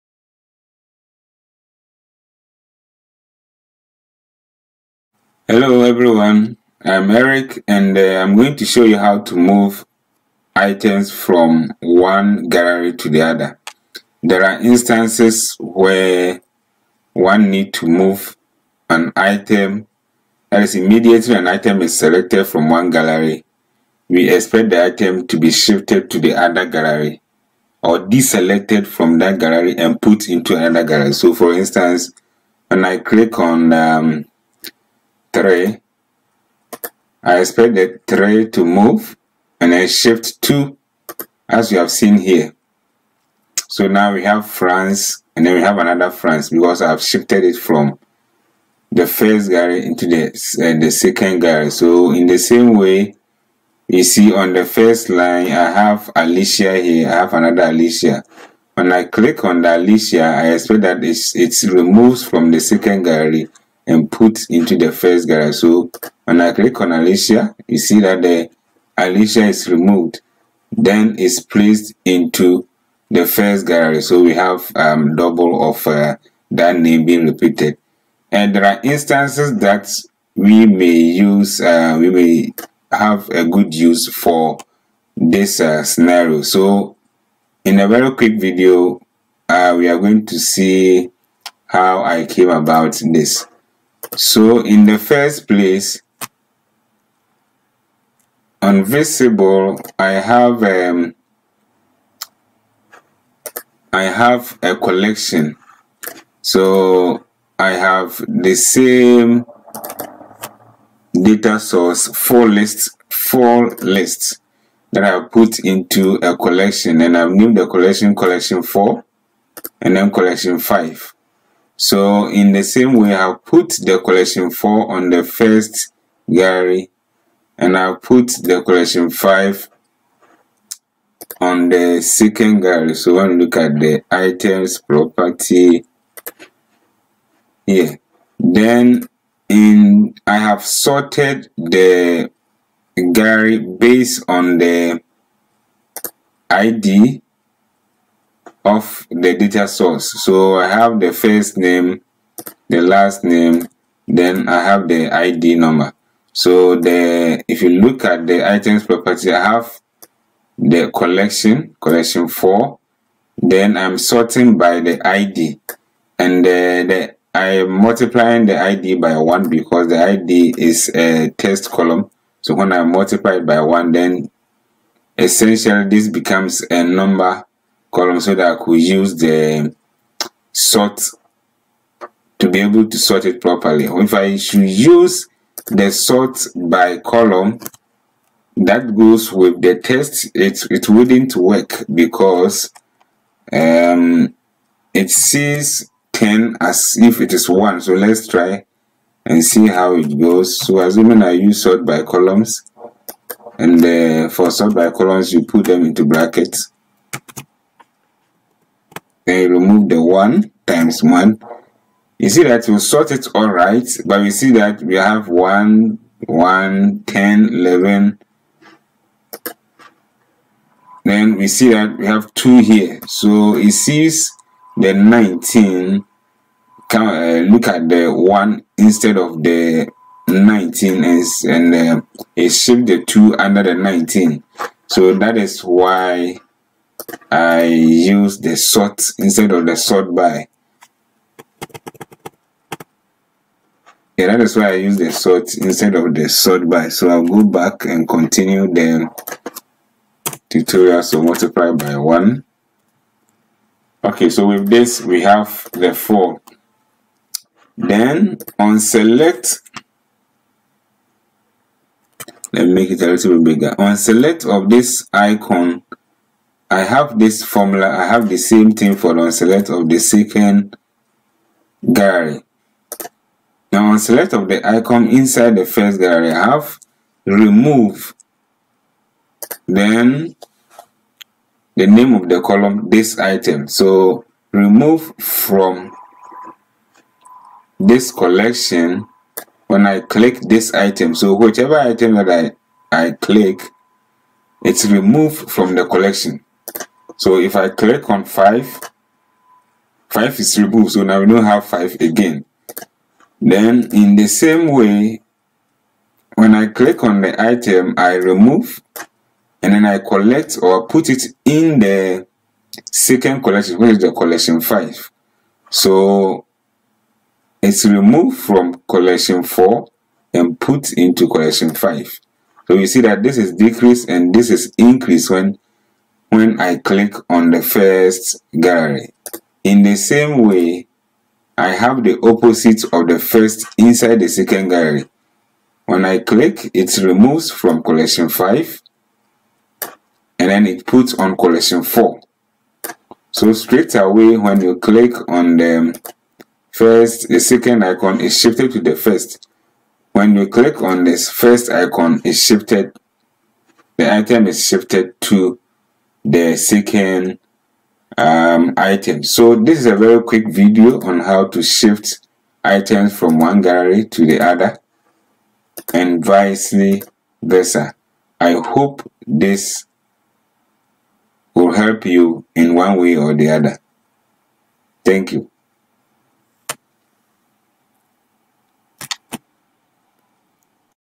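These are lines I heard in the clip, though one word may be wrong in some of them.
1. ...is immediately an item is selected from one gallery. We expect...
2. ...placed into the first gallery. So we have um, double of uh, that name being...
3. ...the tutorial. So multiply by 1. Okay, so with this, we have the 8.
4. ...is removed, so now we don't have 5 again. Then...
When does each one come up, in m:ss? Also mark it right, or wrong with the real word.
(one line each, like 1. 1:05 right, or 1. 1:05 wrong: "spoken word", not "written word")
1. 0:20 right
2. 1:11 right
3. 4:08 wrong: "4", not "8"
4. 5:00 right.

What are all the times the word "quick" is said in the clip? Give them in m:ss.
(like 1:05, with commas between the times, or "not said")
1:28, 6:00.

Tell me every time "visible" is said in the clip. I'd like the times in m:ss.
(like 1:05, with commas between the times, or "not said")
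1:38.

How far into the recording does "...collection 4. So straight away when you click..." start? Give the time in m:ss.
5:41.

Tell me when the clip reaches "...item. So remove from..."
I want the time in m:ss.
4:43.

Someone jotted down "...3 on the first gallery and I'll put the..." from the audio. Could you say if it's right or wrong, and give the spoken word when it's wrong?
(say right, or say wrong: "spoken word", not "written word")
wrong: "4", not "3".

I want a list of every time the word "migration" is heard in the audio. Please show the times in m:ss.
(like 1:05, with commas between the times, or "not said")
not said.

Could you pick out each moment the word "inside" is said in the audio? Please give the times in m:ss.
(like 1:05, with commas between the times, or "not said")
4:35, 5:33.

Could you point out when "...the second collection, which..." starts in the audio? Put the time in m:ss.
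5:11.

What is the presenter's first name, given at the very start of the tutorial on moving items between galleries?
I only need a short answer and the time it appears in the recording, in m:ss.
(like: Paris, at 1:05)
Eric, at 0:07.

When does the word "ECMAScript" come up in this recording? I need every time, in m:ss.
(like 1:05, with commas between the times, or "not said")
not said.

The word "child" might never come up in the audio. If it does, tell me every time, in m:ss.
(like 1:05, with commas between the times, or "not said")
not said.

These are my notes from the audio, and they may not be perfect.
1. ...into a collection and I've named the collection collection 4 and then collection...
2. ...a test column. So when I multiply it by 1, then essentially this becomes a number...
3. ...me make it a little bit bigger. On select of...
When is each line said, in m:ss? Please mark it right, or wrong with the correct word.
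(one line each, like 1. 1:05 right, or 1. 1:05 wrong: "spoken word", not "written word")
1. 1:55 right
2. 2:50 right
3. 4:22 right.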